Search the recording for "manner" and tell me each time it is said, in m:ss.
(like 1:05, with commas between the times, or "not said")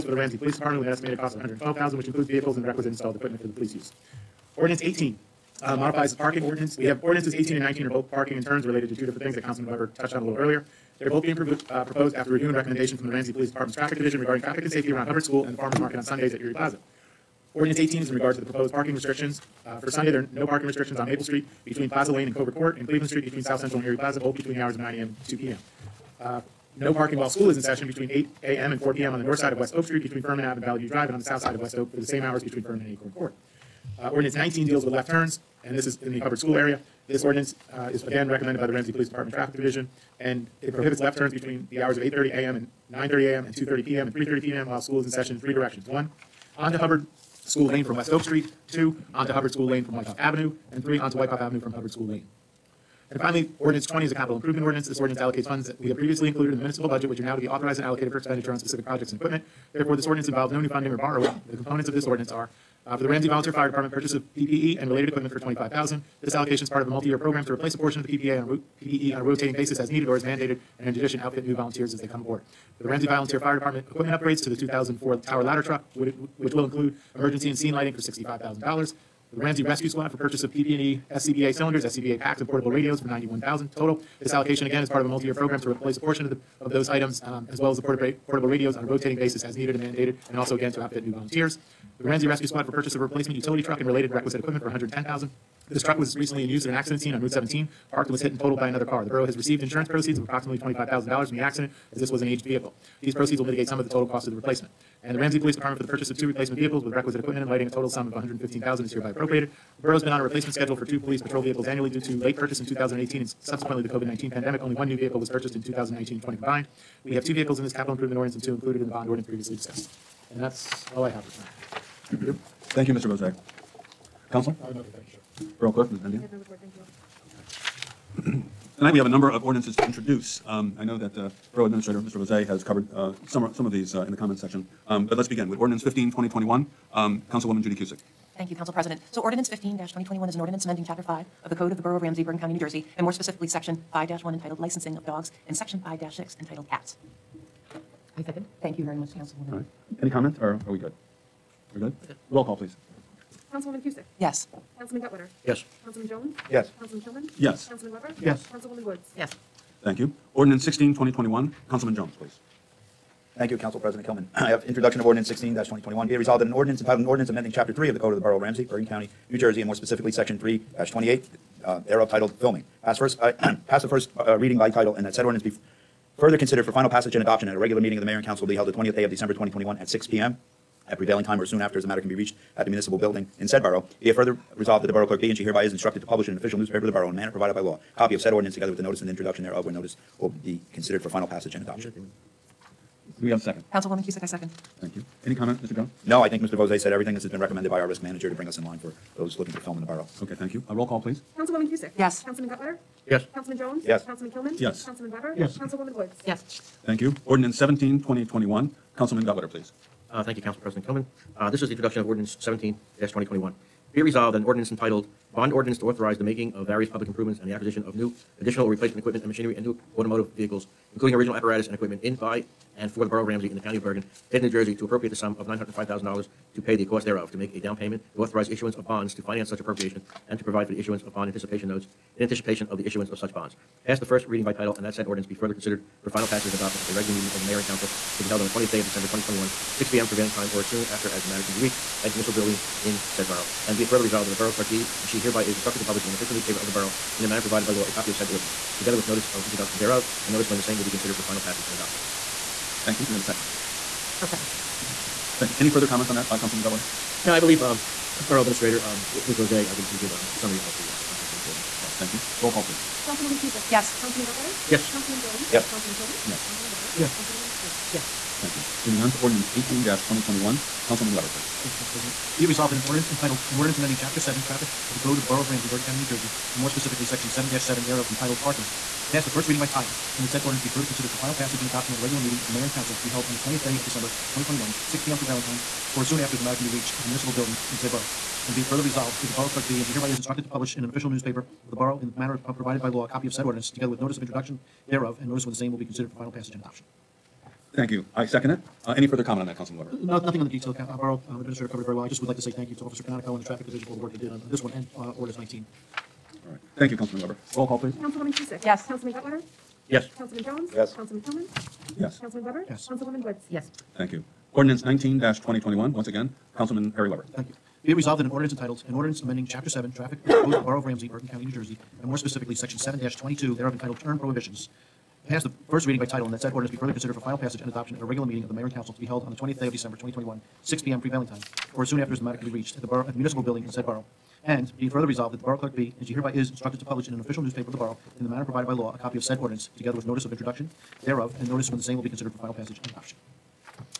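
3:07, 4:07, 4:52, 5:38.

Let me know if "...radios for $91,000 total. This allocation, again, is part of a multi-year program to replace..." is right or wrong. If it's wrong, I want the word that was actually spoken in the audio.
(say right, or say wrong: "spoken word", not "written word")
right.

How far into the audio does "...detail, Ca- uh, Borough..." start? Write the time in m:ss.
5:00.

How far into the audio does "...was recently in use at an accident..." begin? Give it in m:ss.
1:35.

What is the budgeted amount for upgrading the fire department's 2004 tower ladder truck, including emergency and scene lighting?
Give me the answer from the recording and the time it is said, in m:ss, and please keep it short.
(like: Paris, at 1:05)
$65,000, at 1:17.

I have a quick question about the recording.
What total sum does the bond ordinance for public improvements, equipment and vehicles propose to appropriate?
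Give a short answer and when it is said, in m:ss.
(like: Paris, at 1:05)
$905,000, at 3:45.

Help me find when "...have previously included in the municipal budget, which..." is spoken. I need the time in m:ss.
0:55.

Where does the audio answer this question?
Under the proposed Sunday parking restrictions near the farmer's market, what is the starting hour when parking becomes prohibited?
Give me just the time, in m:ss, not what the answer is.
0:24.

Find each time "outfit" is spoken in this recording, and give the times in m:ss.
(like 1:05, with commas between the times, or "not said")
1:11, 1:30.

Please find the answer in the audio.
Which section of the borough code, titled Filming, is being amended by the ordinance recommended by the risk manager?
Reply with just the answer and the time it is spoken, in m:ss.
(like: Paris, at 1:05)
3-28, at 2:50.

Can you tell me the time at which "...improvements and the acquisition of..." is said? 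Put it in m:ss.
3:37.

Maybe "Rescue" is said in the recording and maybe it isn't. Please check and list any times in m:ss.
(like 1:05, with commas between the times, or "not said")
1:19, 1:32.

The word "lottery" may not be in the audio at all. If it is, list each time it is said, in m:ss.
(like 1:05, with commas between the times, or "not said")
not said.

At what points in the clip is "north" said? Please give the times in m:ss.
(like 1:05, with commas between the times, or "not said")
0:29.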